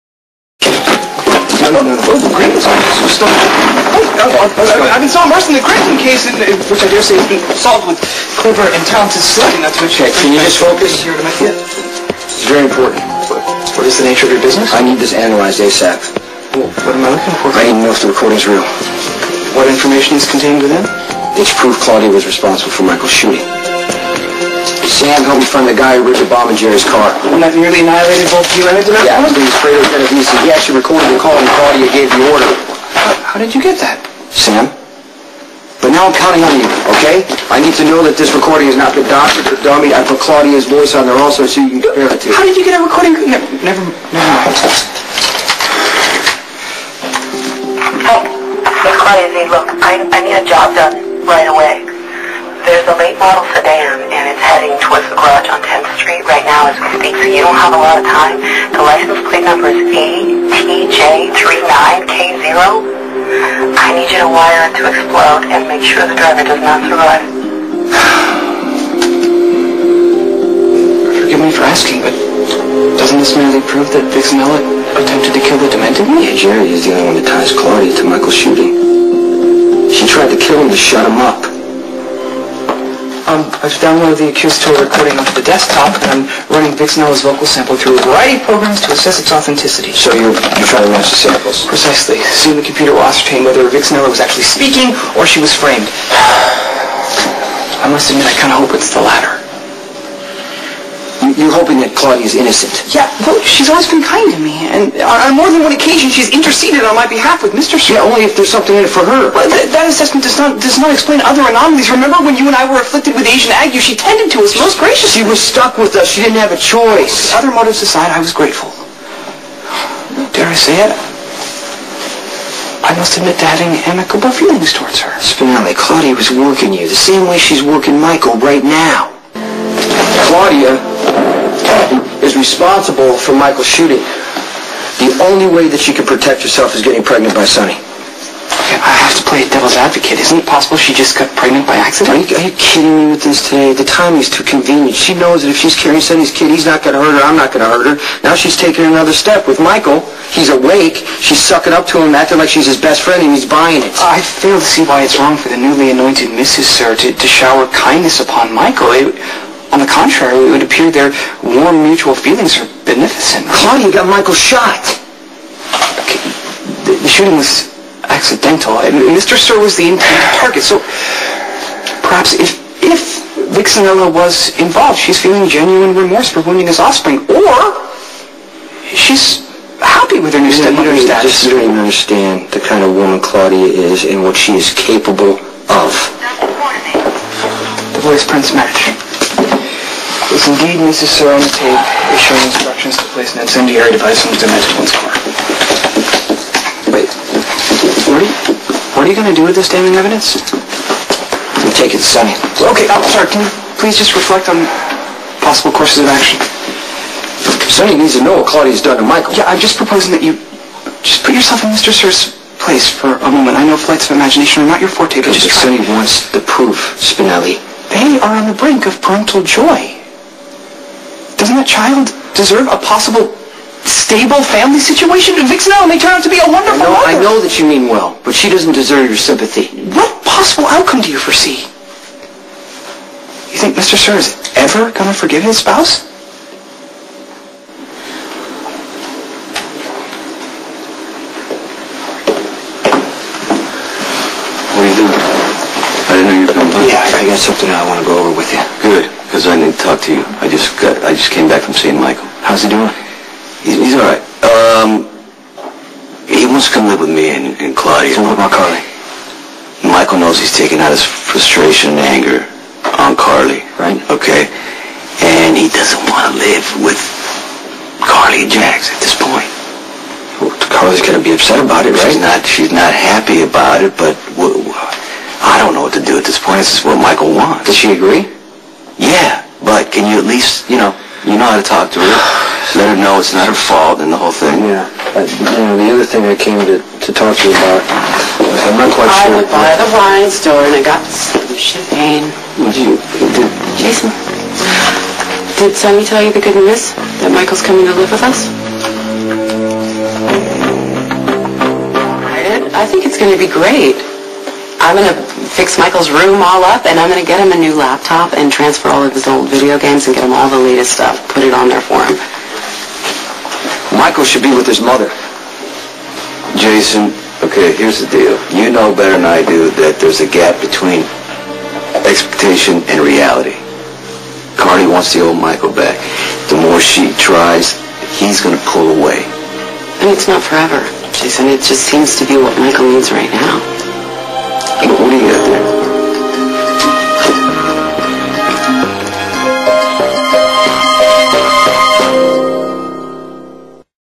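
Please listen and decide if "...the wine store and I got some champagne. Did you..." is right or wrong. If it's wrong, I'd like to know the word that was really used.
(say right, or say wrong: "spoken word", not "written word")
right.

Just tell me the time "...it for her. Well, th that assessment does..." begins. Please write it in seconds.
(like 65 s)
108 s.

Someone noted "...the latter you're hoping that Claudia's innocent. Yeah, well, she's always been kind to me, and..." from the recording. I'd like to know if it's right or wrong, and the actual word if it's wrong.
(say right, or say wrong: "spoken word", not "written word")
right.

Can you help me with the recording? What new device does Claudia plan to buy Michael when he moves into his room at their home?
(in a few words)
laptop.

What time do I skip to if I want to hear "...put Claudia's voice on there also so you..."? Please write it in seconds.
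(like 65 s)
40 s.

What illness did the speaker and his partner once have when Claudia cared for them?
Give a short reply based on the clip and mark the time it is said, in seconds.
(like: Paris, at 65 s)
Asian ague, at 113 s.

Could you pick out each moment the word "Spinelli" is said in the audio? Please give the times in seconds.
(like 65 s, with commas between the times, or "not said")
125 s, 217 s.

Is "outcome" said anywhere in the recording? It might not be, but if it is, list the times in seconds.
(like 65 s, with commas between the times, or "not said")
230 s.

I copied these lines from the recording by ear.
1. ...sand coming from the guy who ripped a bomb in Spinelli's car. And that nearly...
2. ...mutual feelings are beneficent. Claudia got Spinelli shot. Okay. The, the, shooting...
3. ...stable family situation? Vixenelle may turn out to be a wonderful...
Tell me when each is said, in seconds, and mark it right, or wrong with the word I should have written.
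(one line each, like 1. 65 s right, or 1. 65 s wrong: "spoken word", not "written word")
1. 24 s wrong: "Jerry", not "Spinelli"
2. 161 s wrong: "Michael", not "Spinelli"
3. 223 s right.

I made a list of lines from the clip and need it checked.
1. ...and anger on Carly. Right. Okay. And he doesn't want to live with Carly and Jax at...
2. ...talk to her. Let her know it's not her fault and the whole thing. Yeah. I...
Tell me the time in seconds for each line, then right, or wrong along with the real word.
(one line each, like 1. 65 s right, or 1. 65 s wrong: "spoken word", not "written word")
1. 262 s right
2. 281 s right.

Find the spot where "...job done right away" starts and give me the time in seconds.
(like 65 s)
50 s.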